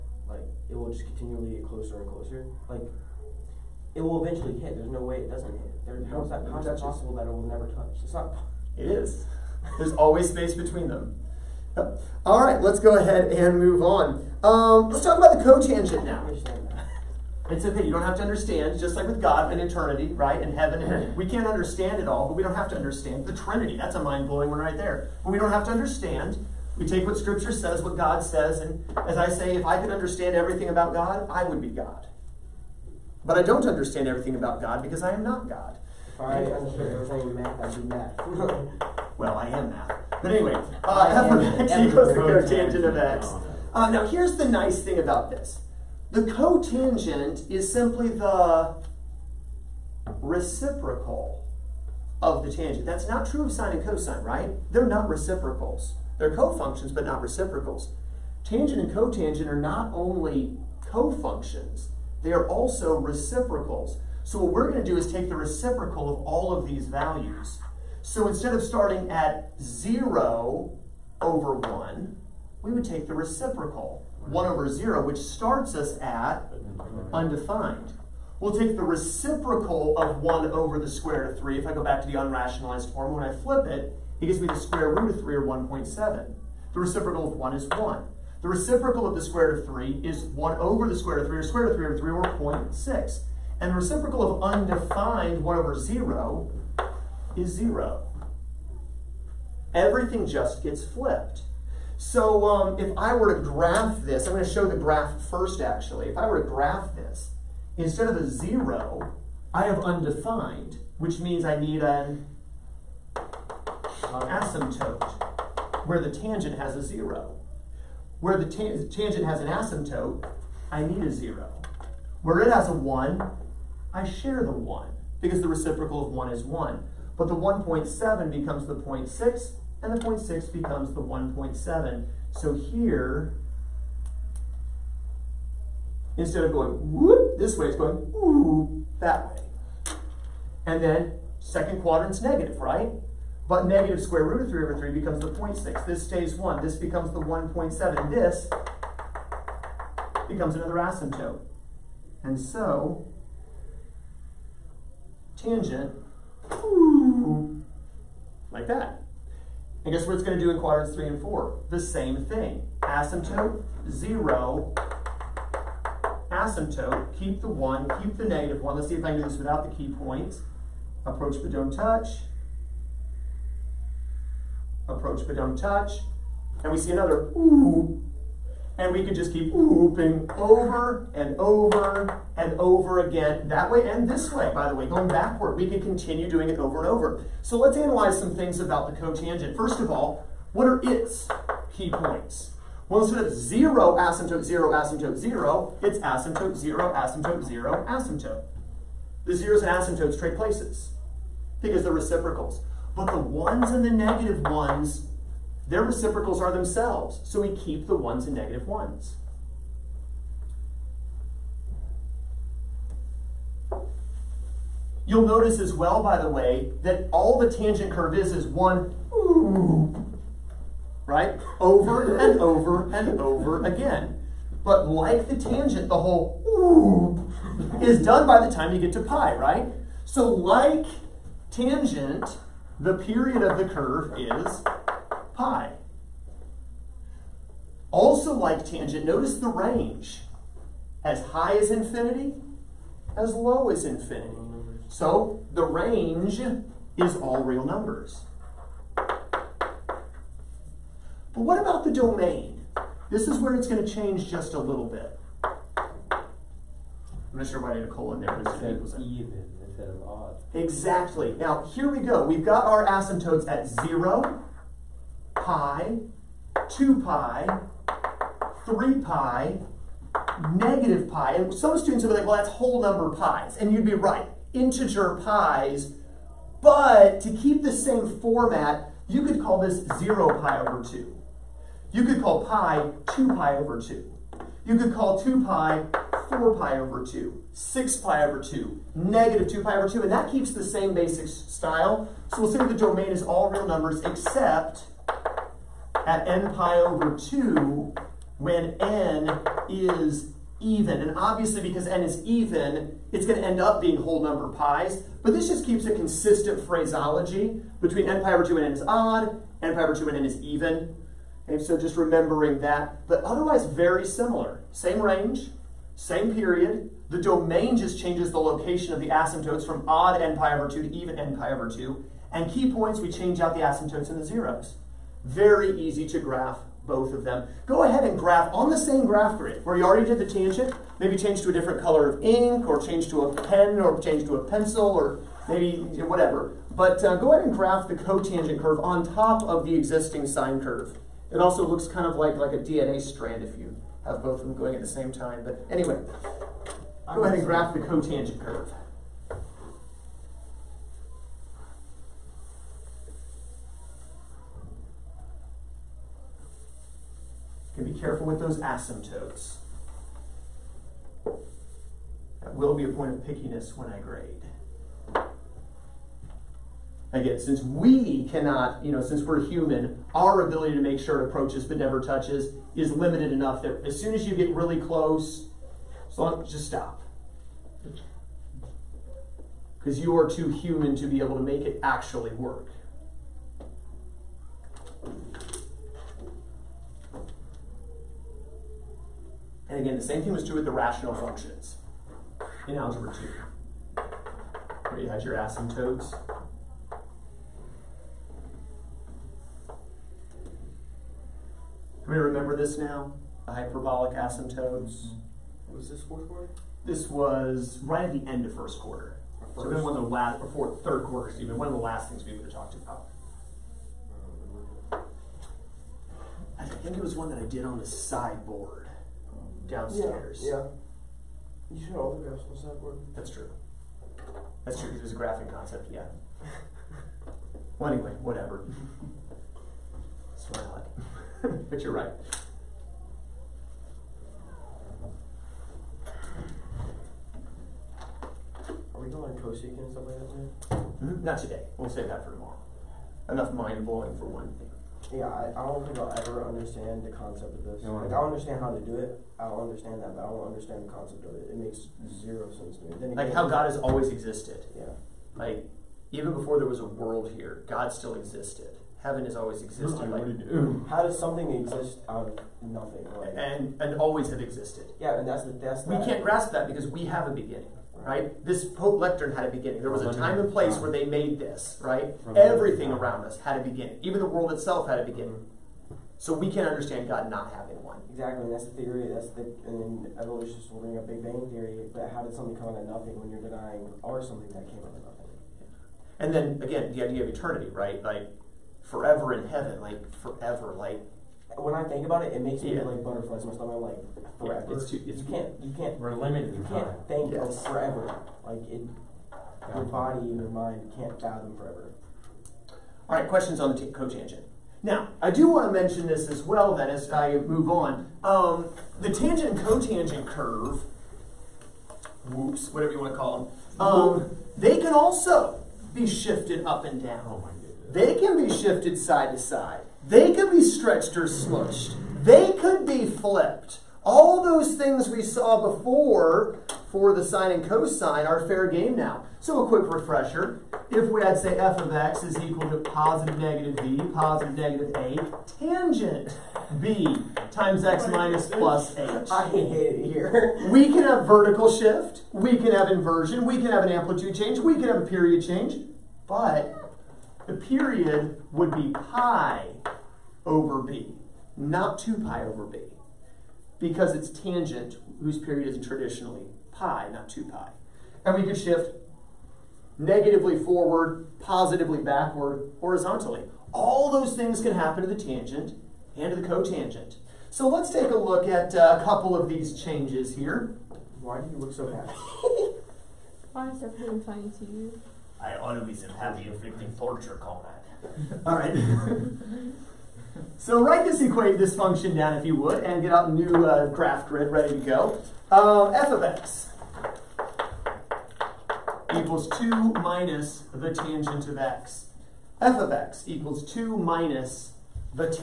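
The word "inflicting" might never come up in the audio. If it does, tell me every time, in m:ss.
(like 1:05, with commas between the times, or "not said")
9:36.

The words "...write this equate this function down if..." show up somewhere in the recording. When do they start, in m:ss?
9:40.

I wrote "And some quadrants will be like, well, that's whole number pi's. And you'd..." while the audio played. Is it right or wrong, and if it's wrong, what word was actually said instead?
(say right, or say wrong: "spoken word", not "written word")
wrong: "students", not "quadrants".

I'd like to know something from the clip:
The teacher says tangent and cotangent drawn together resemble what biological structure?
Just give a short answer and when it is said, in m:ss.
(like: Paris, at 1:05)
a DNA strand, at 5:42.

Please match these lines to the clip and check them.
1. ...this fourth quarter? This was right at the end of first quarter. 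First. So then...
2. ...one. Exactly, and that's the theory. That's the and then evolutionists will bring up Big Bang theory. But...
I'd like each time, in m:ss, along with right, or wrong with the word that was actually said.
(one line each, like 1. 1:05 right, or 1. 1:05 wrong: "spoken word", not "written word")
1. 6:45 right
2. 7:57 right.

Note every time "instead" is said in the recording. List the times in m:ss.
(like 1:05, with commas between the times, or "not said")
1:08, 1:47, 2:16, 3:13, 4:19.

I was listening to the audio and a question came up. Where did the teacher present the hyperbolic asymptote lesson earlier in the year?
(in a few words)
the sideboard downstairs.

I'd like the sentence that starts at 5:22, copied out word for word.
And key points, we change out the asymptotes and the zeros.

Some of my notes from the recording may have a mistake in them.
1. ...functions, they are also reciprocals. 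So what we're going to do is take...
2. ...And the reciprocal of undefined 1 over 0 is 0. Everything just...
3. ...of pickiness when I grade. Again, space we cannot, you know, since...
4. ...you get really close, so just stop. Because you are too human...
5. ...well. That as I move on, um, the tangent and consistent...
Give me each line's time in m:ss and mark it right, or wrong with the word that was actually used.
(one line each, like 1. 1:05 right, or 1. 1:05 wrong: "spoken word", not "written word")
1. 1:00 wrong: "cofunctions", not "functions"
2. 1:33 right
3. 6:03 wrong: "since", not "space"
4. 6:14 right
5. 8:26 wrong: "cotangent", not "consistent".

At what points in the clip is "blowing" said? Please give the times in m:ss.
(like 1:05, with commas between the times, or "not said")
0:24, 7:23.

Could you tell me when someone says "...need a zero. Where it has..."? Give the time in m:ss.
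2:00.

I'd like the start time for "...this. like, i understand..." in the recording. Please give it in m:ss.
7:27.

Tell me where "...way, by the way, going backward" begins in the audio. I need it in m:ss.
3:04.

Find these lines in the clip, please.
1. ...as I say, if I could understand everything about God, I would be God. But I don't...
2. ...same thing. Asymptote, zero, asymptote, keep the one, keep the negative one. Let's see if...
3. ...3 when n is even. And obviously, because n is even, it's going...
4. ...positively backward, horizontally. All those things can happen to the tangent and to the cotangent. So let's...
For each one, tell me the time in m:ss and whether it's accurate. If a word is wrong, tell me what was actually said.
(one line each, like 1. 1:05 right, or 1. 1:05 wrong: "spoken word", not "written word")
1. 0:29 right
2. 2:41 right
3. 4:57 wrong: "2", not "3"
4. 9:21 right.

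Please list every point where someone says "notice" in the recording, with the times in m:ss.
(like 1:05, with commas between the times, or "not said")
3:35, 3:59.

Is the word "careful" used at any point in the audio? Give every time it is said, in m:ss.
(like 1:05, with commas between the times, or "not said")
5:57.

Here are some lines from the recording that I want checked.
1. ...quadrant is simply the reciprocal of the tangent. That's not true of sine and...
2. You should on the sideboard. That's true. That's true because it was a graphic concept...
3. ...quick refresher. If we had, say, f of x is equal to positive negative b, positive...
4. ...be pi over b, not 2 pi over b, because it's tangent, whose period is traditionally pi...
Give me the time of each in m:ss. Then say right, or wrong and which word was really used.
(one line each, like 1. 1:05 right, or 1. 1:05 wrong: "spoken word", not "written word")
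1. 0:46 wrong: "cotangent", not "quadrant"
2. 7:01 right
3. 8:49 right
4. 9:08 right.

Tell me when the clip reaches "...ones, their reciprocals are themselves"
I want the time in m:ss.
3:24.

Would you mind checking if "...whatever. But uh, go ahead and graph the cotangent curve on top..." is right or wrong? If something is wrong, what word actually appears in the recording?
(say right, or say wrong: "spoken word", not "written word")
right.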